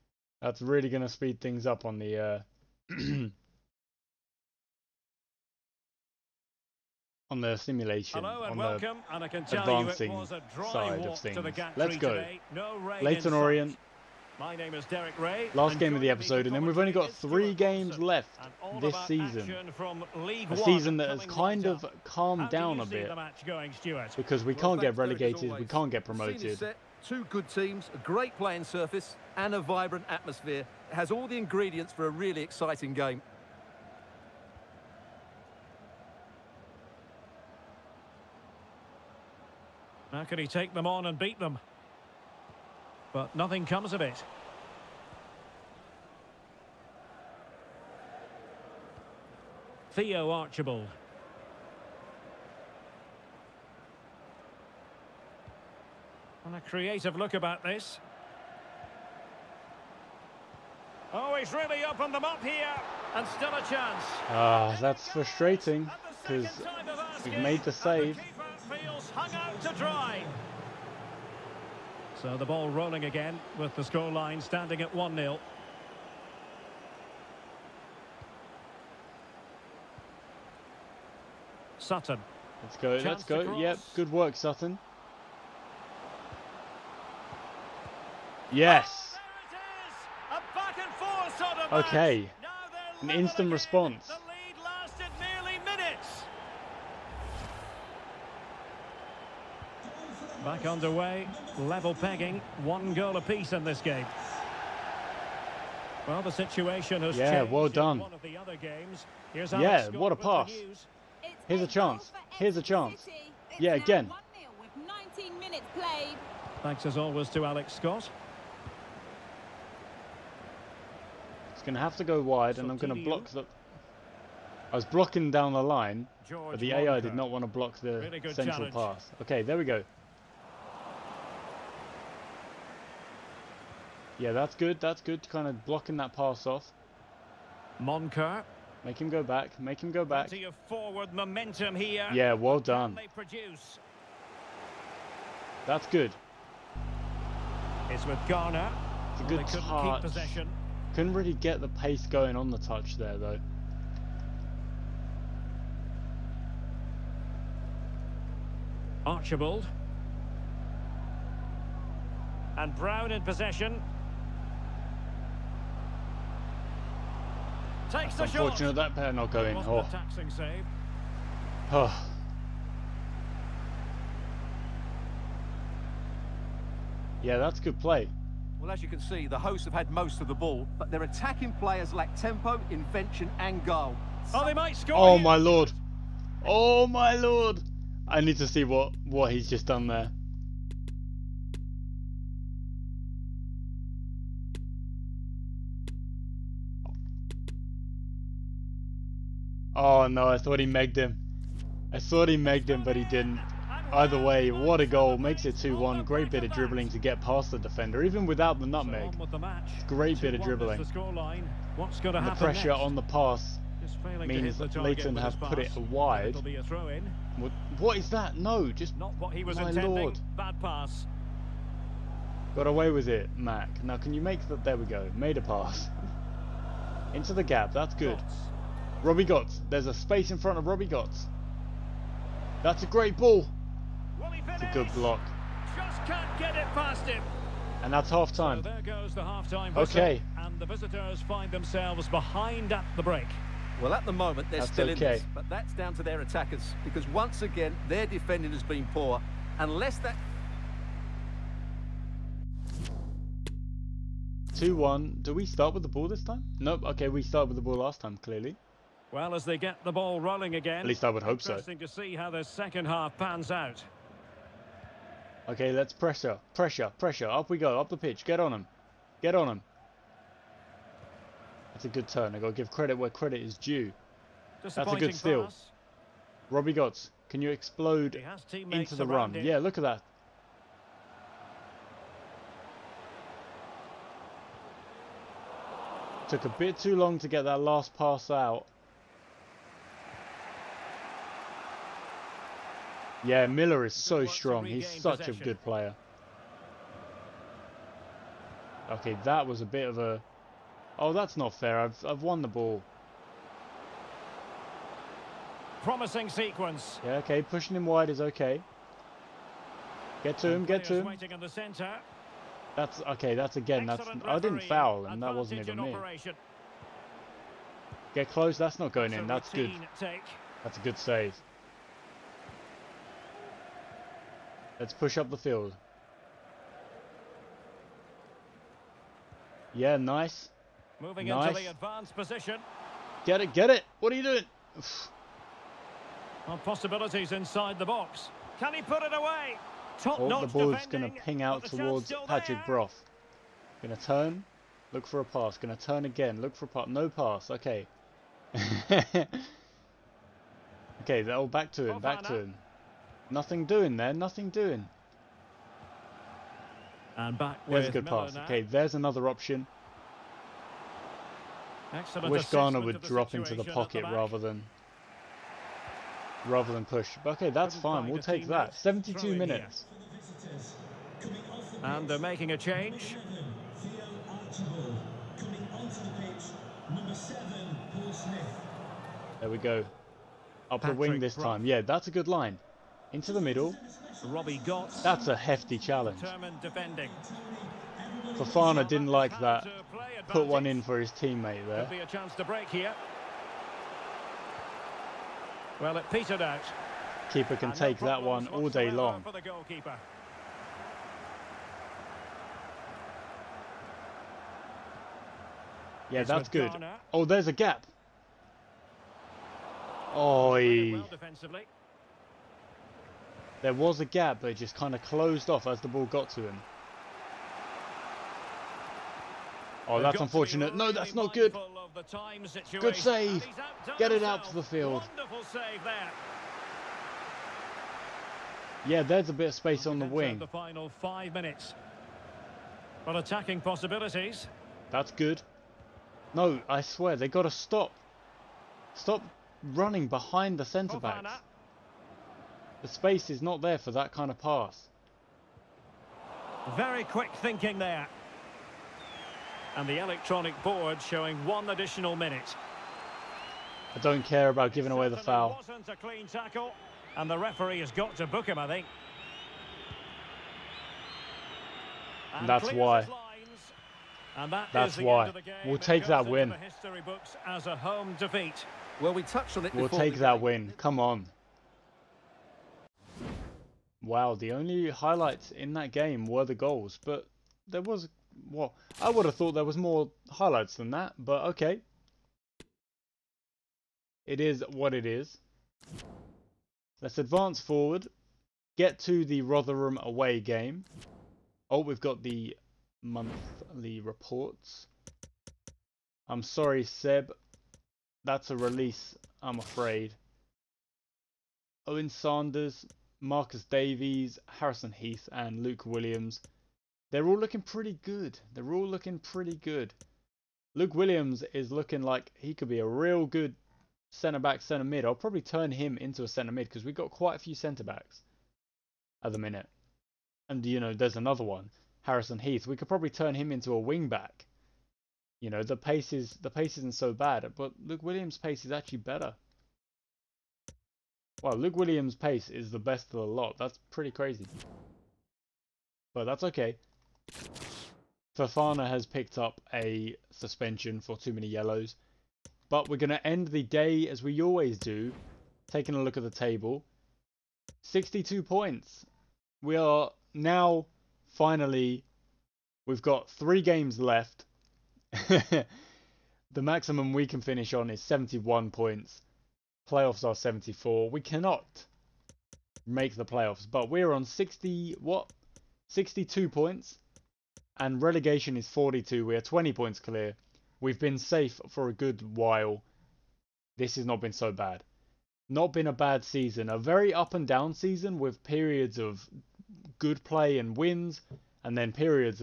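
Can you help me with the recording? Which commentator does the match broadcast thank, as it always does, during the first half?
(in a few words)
Alex Scott.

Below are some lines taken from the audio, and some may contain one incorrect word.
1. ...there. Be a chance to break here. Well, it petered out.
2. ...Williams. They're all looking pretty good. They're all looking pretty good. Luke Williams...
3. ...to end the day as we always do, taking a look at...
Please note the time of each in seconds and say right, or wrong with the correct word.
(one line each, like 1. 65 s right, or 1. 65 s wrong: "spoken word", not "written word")
1. 391 s right
2. 505 s right
3. 543 s right.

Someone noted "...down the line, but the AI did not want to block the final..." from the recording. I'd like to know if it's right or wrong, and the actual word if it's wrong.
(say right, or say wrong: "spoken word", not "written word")
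wrong: "central", not "final".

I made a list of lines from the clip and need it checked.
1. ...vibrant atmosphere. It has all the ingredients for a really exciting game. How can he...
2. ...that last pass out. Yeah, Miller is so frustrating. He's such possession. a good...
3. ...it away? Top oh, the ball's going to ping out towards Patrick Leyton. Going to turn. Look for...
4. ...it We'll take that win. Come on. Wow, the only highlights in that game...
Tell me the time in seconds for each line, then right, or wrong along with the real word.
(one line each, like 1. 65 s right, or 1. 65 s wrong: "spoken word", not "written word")
1. 29 s right
2. 287 s wrong: "strong", not "frustrating"
3. 339 s wrong: "Broth", not "Leyton"
4. 469 s right.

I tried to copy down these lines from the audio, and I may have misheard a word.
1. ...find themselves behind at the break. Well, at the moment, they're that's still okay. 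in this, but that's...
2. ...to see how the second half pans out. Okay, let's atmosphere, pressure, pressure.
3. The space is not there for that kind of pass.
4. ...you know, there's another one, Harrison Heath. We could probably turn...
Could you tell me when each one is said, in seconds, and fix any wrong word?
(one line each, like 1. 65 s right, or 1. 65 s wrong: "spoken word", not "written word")
1. 241 s right
2. 261 s wrong: "pressure", not "atmosphere"
3. 442 s right
4. 520 s right.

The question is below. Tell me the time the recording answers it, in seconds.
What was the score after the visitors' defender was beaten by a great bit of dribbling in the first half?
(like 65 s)
205 s.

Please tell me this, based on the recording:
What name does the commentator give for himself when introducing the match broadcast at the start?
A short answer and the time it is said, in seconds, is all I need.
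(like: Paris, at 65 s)
Derek Ray, at 14 s.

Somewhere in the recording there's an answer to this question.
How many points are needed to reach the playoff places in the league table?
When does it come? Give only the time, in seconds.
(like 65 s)
559 s.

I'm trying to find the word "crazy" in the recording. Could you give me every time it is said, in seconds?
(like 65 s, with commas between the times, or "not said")
534 s.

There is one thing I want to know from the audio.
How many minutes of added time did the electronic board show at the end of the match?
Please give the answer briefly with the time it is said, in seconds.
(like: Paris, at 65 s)
1, at 451 s.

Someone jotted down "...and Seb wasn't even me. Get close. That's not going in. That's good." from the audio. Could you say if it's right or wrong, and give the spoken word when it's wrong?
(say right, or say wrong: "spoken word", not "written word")
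wrong: "That", not "Seb".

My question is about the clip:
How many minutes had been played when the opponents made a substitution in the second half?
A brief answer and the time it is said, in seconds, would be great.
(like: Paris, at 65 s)
72, at 368 s.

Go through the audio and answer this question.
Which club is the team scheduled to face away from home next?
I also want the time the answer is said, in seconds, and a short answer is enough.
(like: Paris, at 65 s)
Rotherham, at 489 s.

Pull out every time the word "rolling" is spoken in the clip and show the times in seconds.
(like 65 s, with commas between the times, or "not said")
72 s, 260 s.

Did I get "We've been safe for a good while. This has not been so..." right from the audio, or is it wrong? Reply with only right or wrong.
right.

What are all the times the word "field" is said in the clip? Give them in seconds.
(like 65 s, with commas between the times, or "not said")
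325 s, 424 s.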